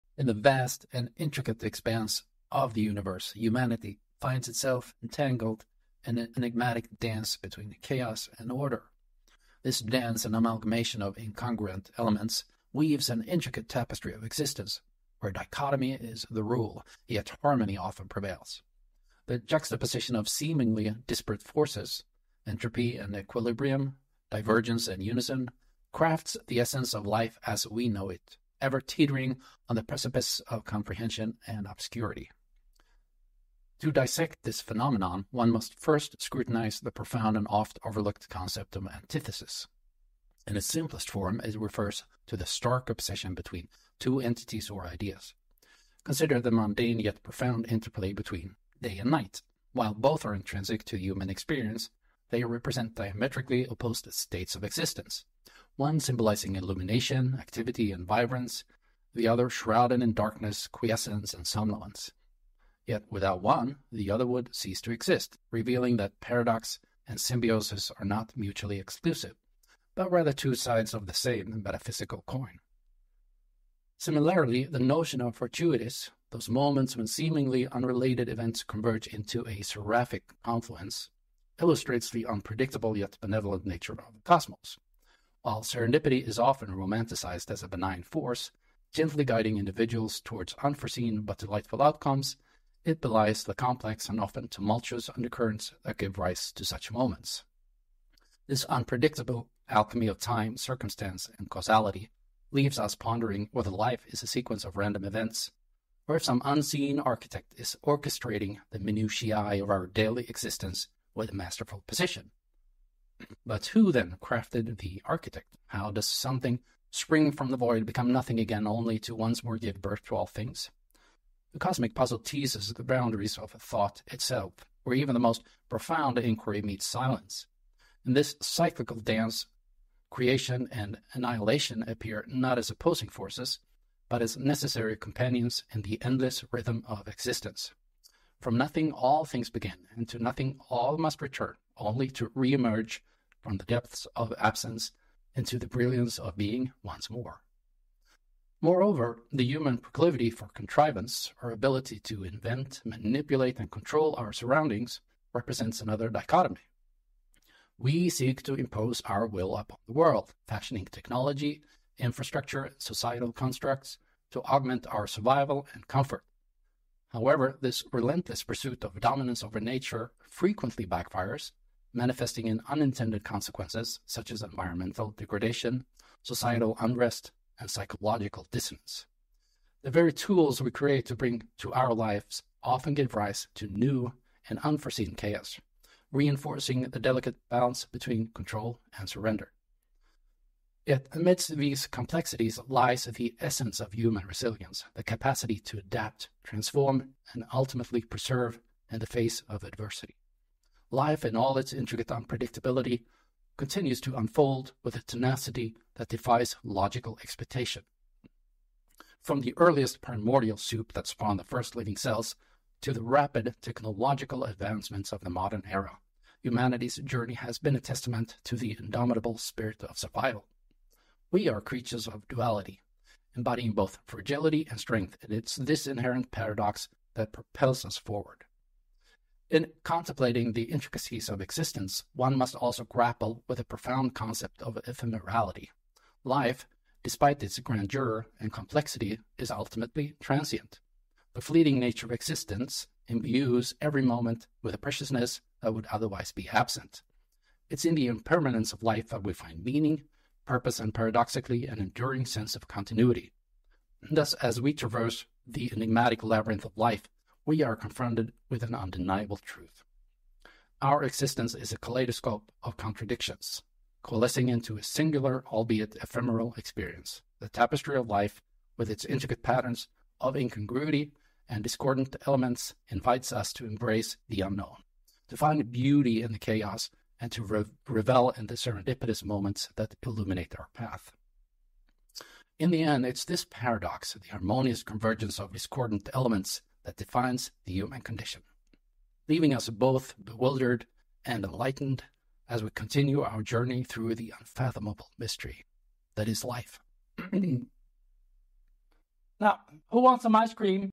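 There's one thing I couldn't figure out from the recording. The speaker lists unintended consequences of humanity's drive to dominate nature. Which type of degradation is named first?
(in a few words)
environmental degradation.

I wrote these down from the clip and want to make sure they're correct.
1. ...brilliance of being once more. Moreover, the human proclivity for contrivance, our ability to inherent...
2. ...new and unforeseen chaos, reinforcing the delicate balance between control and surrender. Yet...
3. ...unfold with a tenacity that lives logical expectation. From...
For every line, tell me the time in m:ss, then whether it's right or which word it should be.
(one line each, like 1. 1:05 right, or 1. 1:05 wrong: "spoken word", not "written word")
1. 2:25 wrong: "invent", not "inherent"
2. 3:03 right
3. 3:24 wrong: "defies", not "lives".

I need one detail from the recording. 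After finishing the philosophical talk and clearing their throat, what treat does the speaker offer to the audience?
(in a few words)
ice cream.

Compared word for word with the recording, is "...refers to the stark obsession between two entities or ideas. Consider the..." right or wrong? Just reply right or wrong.
right.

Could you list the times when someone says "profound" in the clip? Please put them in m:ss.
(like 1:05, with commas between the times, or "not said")
0:36, 0:47, 2:05, 3:53.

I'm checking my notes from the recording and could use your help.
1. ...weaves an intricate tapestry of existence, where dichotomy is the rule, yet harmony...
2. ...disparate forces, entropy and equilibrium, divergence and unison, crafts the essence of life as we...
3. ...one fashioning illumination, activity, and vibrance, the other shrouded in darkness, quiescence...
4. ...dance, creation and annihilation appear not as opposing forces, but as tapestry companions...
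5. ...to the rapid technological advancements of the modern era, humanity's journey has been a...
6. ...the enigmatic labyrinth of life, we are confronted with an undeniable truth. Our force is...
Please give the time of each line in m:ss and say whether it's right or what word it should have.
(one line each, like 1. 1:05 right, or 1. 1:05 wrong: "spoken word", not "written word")
1. 0:12 right
2. 0:21 right
3. 0:55 wrong: "symbolizing", not "fashioning"
4. 2:08 wrong: "necessary", not "tapestry"
5. 3:32 right
6. 4:15 wrong: "existence", not "force".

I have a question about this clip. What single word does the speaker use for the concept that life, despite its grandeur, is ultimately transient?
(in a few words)
ephemerality.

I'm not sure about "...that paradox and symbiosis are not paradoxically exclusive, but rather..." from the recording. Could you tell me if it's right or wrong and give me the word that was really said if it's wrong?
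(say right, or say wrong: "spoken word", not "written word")
wrong: "mutually", not "paradoxically".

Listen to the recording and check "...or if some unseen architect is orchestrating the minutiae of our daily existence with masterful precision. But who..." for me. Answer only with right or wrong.
right.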